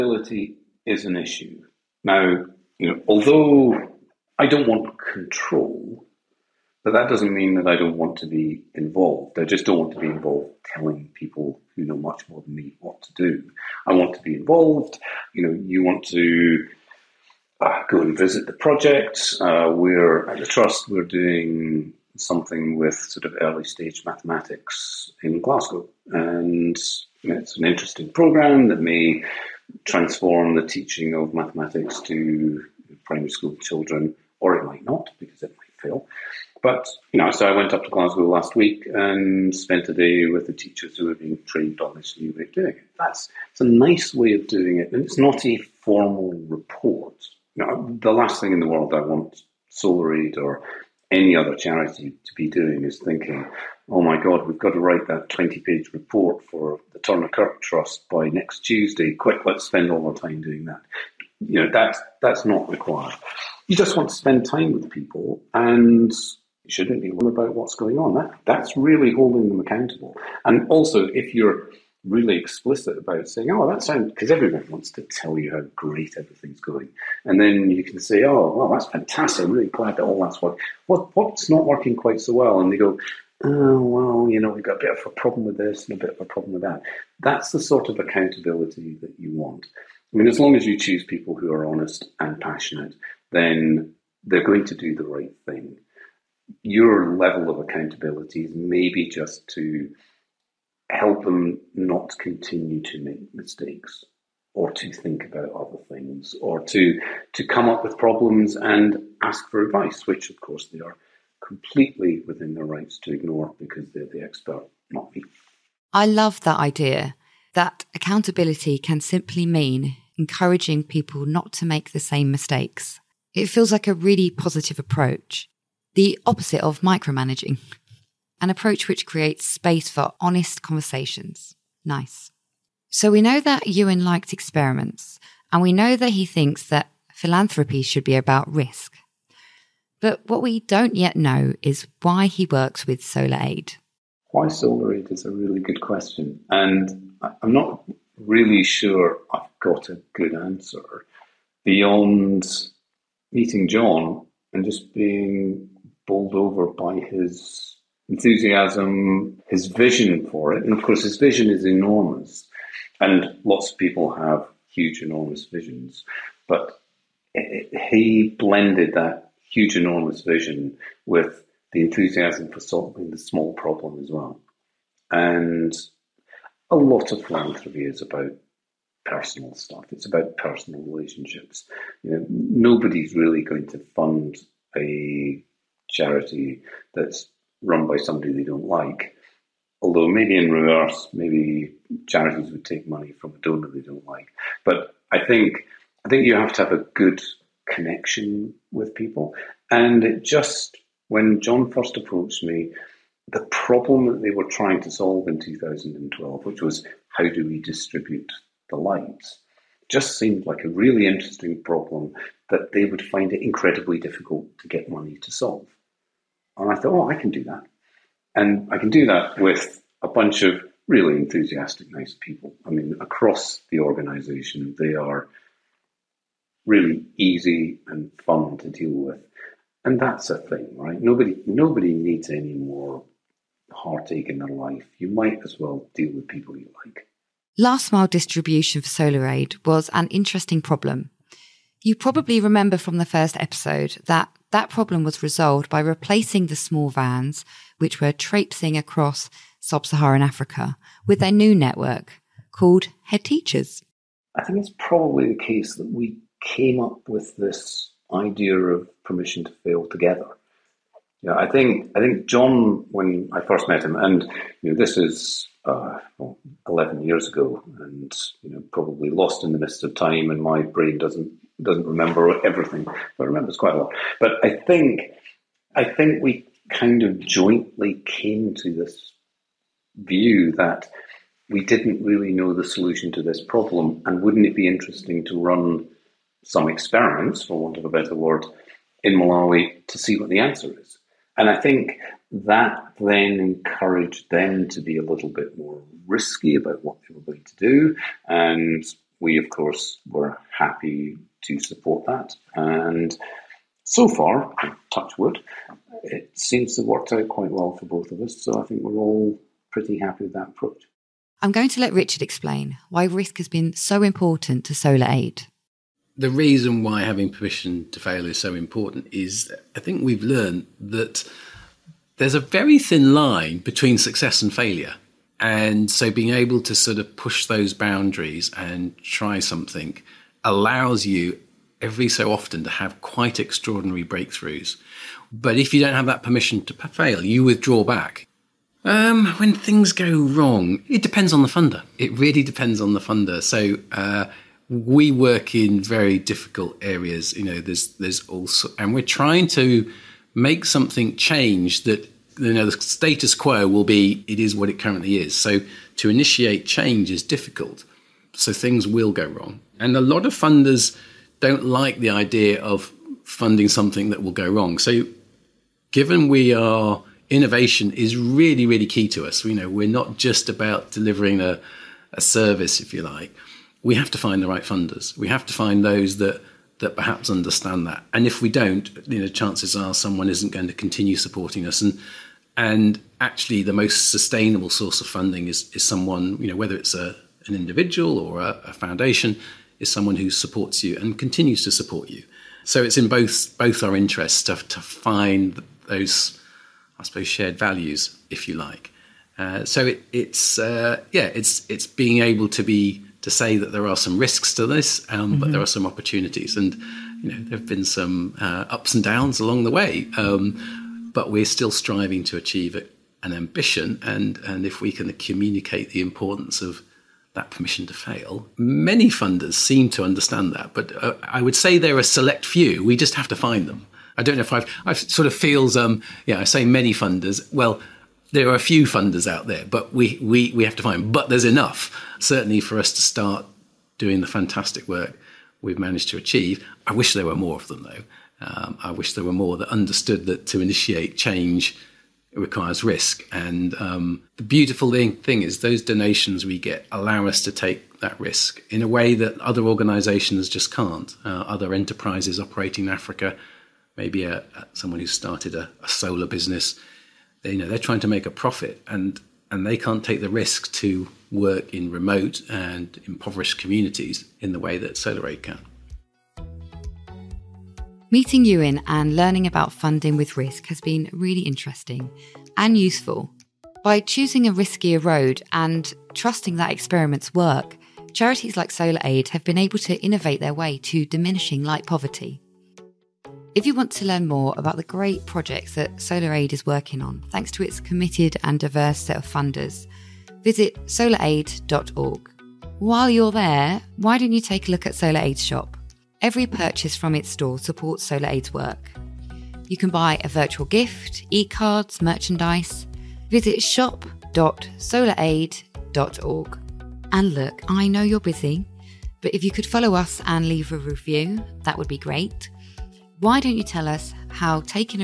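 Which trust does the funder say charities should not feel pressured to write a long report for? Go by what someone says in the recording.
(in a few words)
Turner Kirk Trust.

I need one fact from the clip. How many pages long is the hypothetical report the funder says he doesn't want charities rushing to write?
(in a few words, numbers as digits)
20.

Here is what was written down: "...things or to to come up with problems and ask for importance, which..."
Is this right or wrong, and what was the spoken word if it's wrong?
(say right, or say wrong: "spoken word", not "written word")
wrong: "advice", not "importance".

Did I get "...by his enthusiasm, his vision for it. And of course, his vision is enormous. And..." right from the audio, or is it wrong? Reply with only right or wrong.
right.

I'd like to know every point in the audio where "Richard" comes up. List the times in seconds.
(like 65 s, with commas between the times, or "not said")
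311 s.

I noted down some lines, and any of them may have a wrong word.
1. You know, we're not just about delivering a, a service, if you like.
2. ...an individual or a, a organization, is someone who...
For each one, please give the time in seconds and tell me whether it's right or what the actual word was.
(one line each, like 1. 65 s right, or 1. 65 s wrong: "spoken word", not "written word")
1. 369 s right
2. 387 s wrong: "foundation", not "organization".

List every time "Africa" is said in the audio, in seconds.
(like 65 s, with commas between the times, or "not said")
250 s, 452 s.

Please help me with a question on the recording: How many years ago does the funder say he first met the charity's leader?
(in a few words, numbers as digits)
11.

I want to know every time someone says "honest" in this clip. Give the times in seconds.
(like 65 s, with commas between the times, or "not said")
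91 s, 130 s.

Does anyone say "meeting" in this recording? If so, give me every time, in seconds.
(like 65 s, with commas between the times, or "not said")
153 s, 468 s.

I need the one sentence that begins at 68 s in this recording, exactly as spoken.
That, that's really holding them accountable.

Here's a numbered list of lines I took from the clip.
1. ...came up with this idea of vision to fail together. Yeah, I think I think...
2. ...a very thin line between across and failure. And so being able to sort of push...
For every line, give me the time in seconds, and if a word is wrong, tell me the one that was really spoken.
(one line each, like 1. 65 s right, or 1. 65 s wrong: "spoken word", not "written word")
1. 256 s wrong: "permission", not "vision"
2. 322 s wrong: "success", not "across".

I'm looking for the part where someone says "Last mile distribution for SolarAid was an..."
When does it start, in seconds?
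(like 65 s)
237 s.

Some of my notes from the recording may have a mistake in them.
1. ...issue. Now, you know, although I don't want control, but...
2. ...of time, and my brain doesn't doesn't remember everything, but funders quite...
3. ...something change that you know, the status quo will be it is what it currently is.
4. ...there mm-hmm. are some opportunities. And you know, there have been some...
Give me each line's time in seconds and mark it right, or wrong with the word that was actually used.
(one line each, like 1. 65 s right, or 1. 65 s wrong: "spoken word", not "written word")
1. 1 s right
2. 269 s wrong: "remembers", not "funders"
3. 350 s right
4. 405 s right.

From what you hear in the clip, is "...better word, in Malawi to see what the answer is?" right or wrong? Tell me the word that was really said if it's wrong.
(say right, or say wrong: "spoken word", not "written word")
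right.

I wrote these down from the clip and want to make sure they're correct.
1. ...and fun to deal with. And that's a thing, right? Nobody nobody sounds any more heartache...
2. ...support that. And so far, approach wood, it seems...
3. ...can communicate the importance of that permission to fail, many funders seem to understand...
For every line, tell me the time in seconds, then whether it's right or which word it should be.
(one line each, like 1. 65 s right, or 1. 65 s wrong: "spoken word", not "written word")
1. 227 s wrong: "needs", not "sounds"
2. 301 s wrong: "touch", not "approach"
3. 414 s right.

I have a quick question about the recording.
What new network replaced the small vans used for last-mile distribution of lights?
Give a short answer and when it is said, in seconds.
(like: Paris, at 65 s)
Head Teachers, at 253 s.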